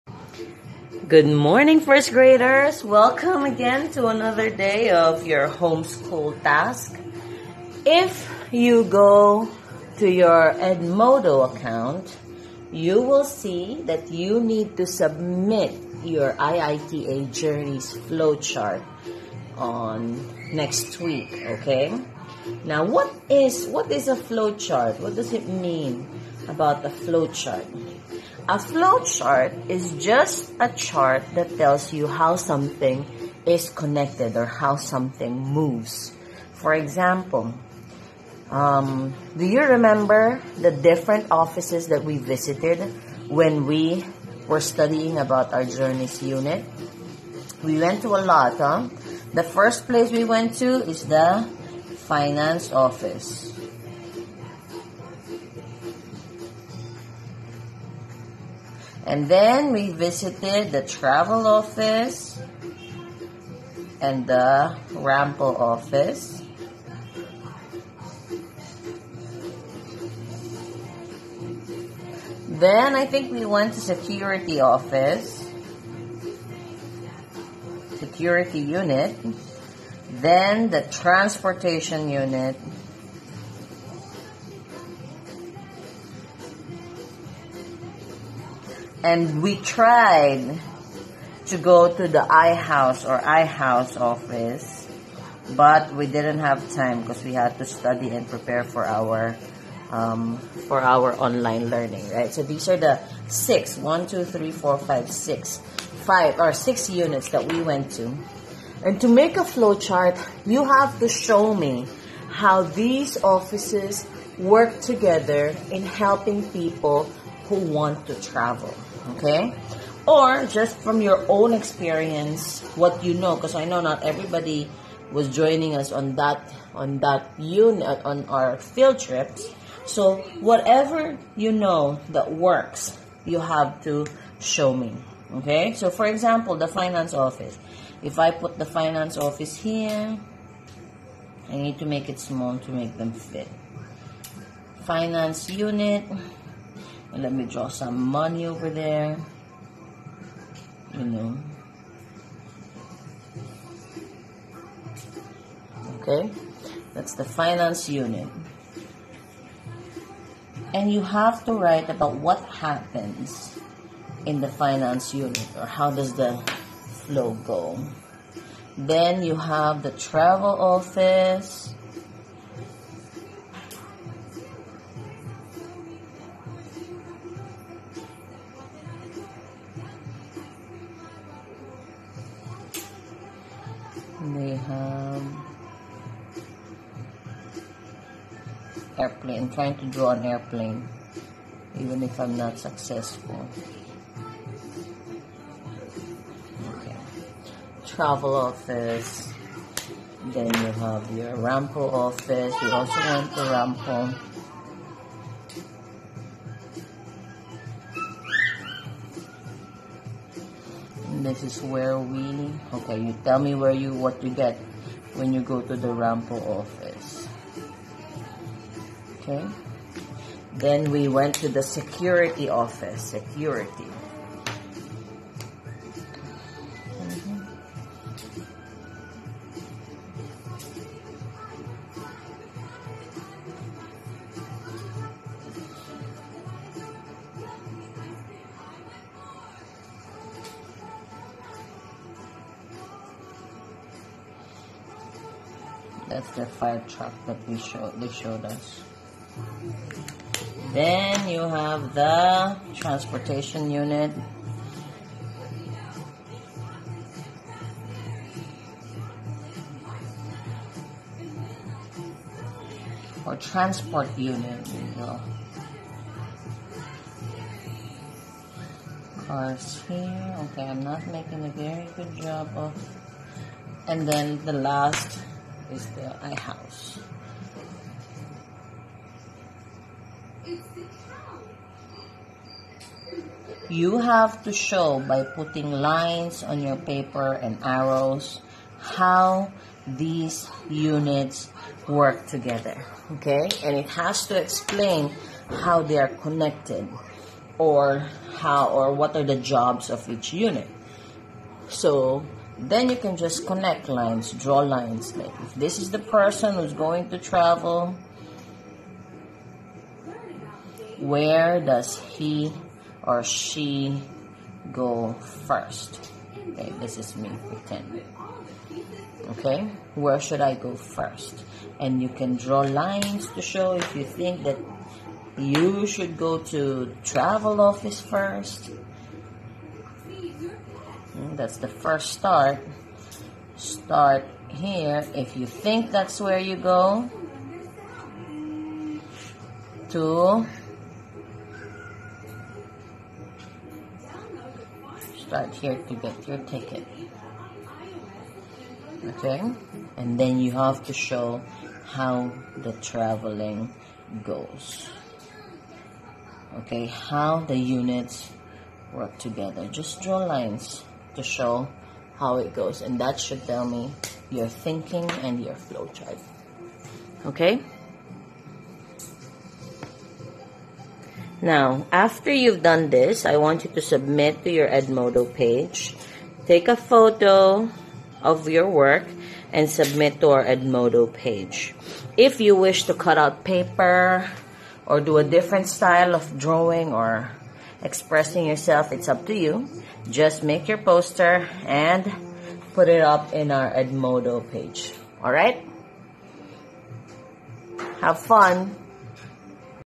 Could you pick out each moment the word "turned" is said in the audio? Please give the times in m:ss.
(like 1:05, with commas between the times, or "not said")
not said.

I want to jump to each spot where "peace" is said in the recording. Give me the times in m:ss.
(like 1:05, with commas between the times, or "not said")
not said.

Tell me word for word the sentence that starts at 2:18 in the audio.
If I put the finance office here, I need to make it small to make them fit.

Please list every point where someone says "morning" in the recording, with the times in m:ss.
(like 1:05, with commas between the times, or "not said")
0:01.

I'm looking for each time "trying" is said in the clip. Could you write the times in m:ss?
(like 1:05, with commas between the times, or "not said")
3:09.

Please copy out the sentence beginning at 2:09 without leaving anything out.
So whatever you know that works, you have to show me.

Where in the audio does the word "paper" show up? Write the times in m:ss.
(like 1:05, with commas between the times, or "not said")
4:46, 6:23.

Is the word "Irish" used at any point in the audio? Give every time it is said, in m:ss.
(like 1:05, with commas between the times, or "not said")
not said.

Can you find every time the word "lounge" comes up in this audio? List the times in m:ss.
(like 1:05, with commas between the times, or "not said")
not said.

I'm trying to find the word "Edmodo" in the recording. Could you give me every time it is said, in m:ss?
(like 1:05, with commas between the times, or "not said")
0:10, 6:14, 6:20, 6:33.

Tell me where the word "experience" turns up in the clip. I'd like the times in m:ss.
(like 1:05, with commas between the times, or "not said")
2:01.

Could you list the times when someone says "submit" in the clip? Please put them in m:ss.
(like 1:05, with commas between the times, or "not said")
0:14, 6:13, 6:19.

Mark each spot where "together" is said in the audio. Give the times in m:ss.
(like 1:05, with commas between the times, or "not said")
1:54, 4:52, 5:59.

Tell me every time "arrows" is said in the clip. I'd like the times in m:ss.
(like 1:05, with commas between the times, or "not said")
4:47.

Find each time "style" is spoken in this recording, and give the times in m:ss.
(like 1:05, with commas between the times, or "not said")
6:25.